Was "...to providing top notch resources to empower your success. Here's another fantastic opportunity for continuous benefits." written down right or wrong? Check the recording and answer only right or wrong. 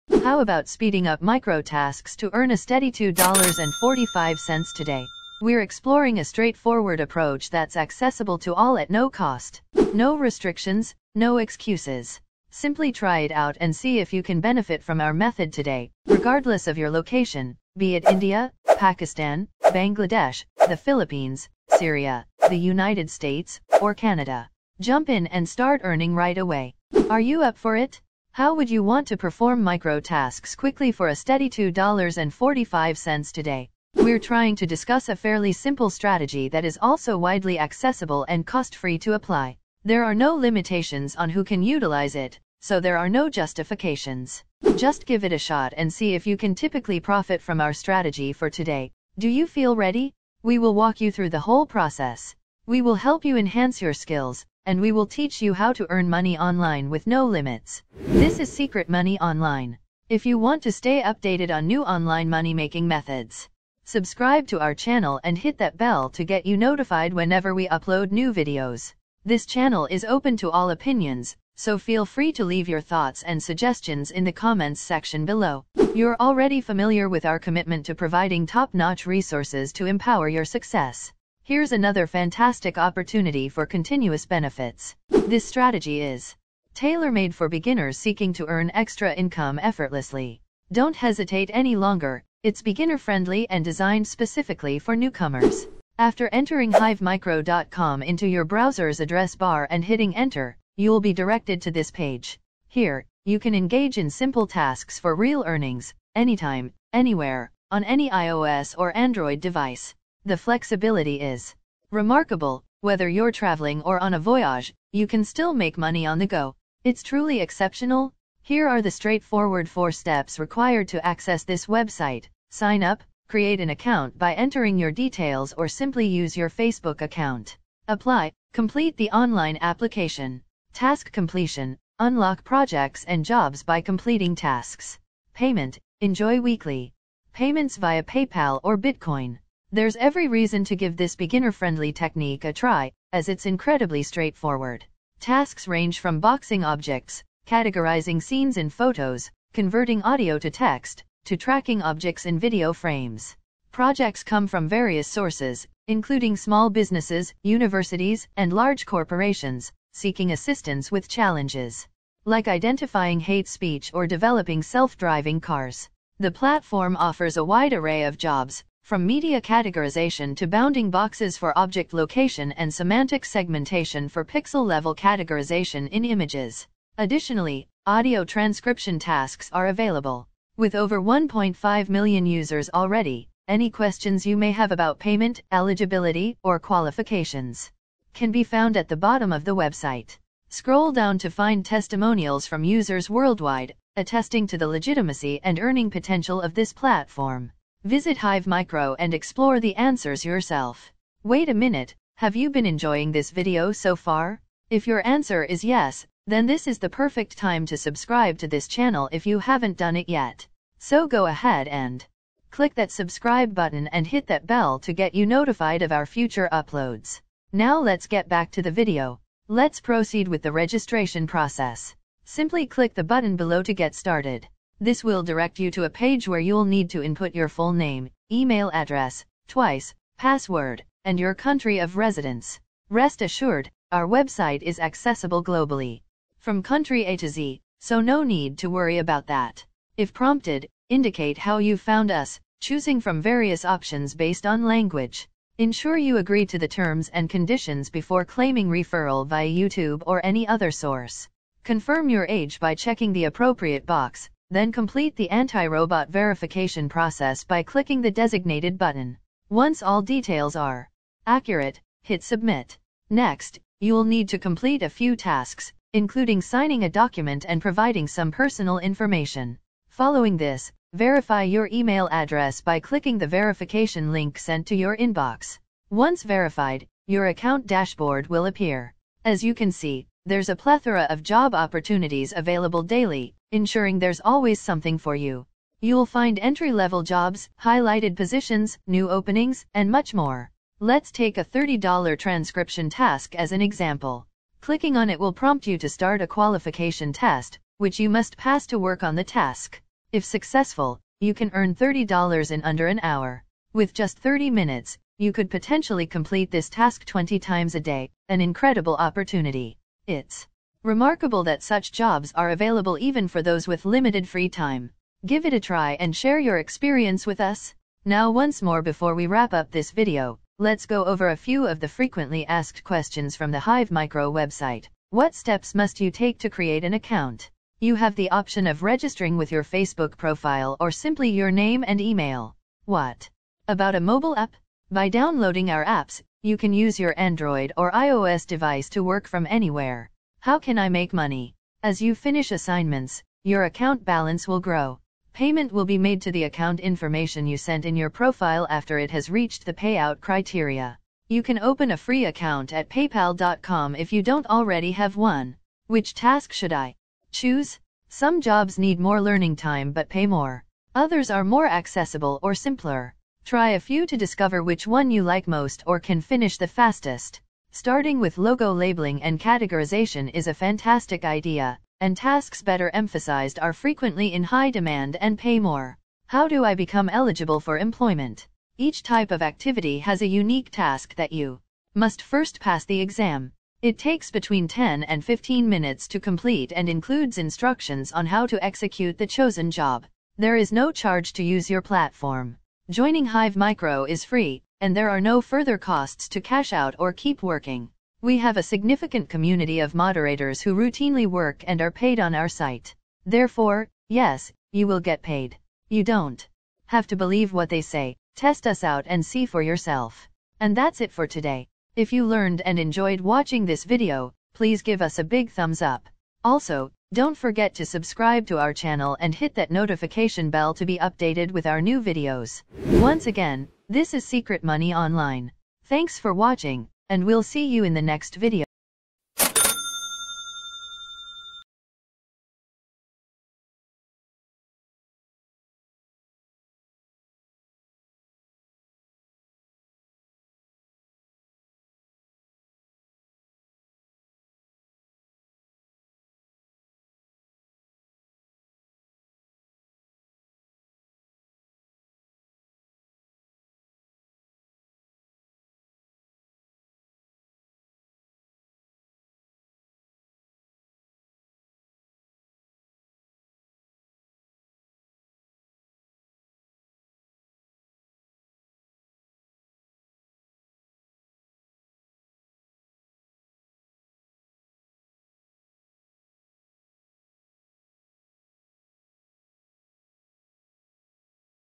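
right.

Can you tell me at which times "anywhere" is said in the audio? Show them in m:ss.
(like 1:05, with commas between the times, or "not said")
1:46, 5:39.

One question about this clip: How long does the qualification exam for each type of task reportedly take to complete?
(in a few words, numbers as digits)
10 to 15 minutes.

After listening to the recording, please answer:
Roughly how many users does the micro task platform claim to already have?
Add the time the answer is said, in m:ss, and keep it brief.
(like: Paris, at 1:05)
1.5 million, at 3:00.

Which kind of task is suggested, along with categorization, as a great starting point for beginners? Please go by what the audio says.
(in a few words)
logo labeling.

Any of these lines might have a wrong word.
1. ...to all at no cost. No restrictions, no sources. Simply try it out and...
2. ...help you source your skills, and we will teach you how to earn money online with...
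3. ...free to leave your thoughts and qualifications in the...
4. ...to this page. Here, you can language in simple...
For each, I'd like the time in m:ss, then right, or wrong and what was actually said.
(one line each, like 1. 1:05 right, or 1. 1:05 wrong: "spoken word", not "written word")
1. 0:08 wrong: "excuses", not "sources"
2. 0:52 wrong: "enhance", not "source"
3. 1:12 wrong: "suggestions", not "qualifications"
4. 1:41 wrong: "engage", not "language".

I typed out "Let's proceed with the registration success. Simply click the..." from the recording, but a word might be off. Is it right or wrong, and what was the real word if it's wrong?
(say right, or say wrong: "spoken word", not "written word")
wrong: "process", not "success".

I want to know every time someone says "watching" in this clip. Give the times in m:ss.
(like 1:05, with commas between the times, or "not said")
6:53, 7:06.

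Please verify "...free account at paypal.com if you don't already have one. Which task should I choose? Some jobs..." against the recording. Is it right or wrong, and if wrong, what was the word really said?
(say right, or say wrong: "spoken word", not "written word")
right.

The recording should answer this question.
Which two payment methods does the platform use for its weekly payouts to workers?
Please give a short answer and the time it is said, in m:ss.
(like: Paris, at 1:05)
PayPal or Bitcoin, at 2:18.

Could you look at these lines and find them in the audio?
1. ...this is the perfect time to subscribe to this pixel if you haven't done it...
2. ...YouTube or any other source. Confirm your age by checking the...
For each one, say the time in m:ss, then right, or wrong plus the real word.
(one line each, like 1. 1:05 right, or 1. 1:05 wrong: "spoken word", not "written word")
1. 3:26 wrong: "channel", not "pixel"
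2. 4:09 right.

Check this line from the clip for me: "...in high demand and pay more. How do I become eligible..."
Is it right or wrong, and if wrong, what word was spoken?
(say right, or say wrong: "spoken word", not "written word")
right.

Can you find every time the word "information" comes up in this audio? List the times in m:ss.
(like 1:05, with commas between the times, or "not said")
4:28, 5:46.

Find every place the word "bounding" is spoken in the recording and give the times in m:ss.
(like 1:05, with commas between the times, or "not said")
2:50.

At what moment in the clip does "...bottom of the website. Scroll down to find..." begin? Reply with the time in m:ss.
3:08.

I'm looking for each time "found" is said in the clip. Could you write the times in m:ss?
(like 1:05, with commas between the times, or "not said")
3:08, 4:01.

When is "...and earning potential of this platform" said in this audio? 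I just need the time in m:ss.
3:15.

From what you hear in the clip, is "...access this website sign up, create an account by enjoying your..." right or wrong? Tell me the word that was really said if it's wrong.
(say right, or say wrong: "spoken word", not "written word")
wrong: "entering", not "enjoying".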